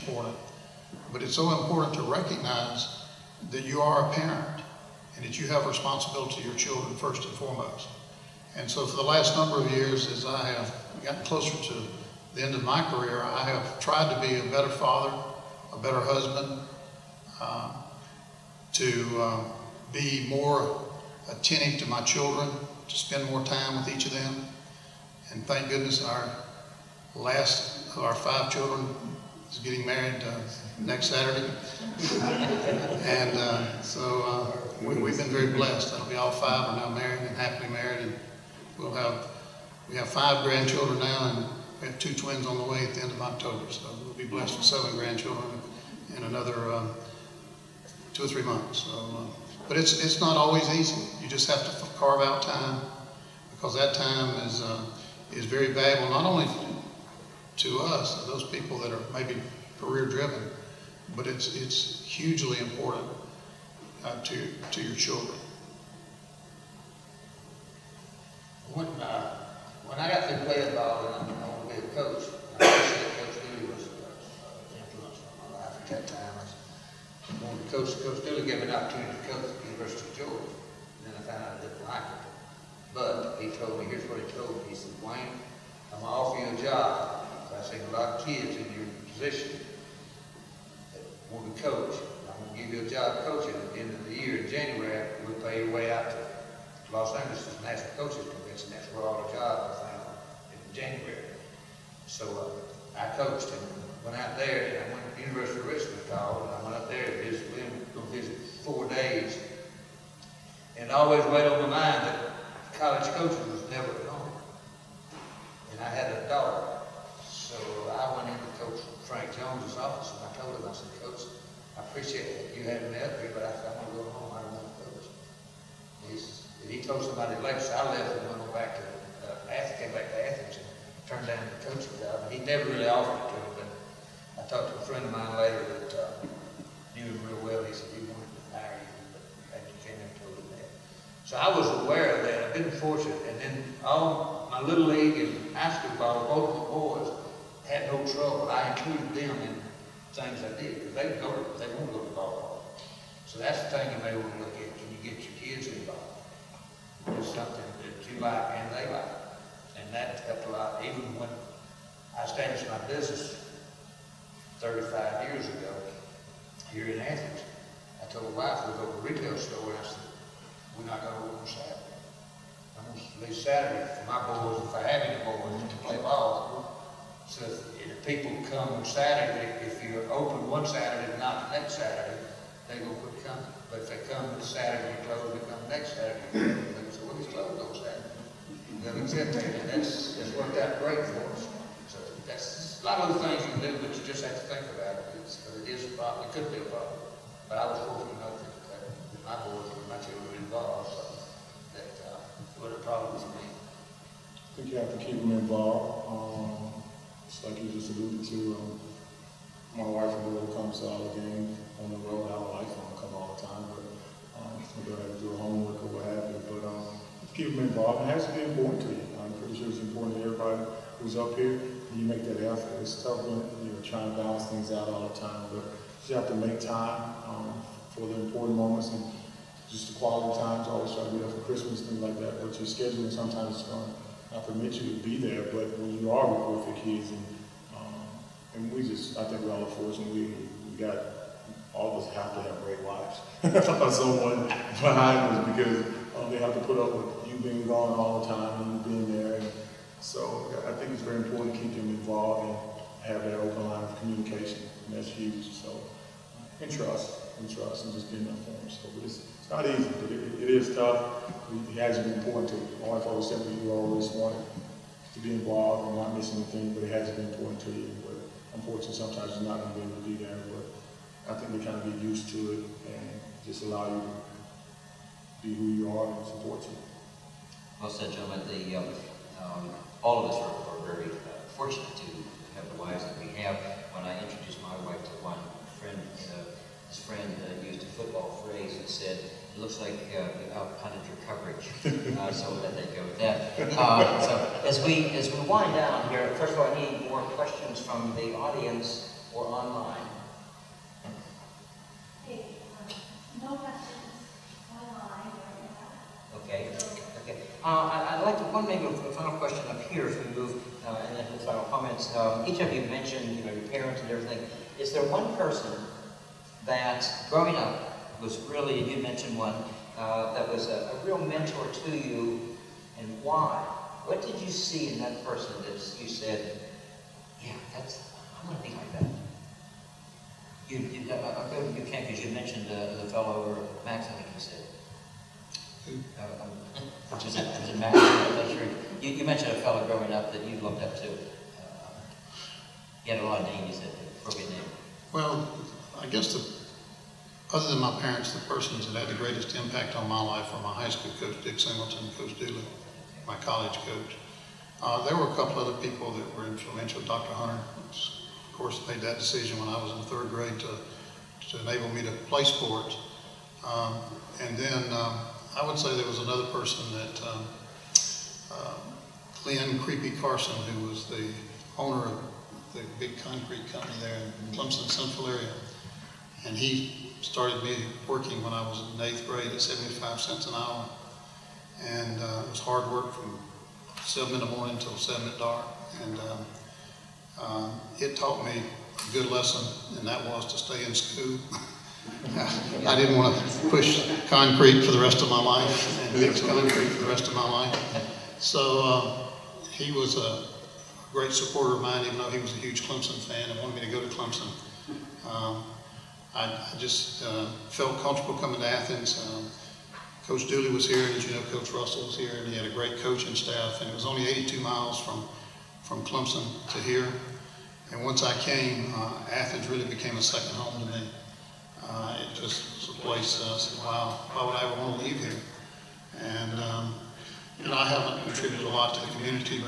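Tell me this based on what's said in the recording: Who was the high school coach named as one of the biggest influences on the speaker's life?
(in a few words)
Dick Singleton.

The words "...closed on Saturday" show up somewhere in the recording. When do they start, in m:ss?
3:07.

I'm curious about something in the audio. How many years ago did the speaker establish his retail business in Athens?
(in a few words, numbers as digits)
35.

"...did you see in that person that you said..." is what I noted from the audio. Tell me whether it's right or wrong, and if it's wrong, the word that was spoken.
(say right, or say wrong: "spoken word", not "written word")
right.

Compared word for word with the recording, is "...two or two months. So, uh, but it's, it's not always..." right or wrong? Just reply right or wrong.
wrong.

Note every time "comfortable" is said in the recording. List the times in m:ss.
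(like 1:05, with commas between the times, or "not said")
6:48.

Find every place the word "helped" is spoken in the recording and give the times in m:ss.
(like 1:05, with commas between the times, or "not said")
2:40.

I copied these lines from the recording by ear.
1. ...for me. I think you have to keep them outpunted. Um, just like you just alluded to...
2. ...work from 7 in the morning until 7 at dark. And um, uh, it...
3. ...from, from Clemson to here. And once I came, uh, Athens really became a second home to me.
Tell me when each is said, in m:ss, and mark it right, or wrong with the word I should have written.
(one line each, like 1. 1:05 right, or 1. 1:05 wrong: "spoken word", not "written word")
1. 3:23 wrong: "involved", not "outpunted"
2. 6:22 right
3. 6:55 right.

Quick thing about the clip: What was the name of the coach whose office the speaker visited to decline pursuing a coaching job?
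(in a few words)
Frank Jones.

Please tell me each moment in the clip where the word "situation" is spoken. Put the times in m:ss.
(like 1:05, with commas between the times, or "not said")
not said.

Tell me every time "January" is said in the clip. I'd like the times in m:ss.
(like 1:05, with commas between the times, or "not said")
1:34, 1:40.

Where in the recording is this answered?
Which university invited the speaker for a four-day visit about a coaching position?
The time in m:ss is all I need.
1:45.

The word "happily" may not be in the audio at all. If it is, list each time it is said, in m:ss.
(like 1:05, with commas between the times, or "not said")
0:37.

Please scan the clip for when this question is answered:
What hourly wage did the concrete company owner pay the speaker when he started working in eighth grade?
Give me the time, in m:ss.
6:19.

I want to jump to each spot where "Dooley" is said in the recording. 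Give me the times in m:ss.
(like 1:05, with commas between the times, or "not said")
1:13, 1:18, 5:52, 6:50.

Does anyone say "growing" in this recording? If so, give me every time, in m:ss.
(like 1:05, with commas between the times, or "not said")
5:17, 5:39.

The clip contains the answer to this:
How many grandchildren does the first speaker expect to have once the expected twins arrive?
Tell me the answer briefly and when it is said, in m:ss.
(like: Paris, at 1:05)
7, at 0:44.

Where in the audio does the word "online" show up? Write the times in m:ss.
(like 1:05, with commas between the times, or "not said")
4:59, 5:04.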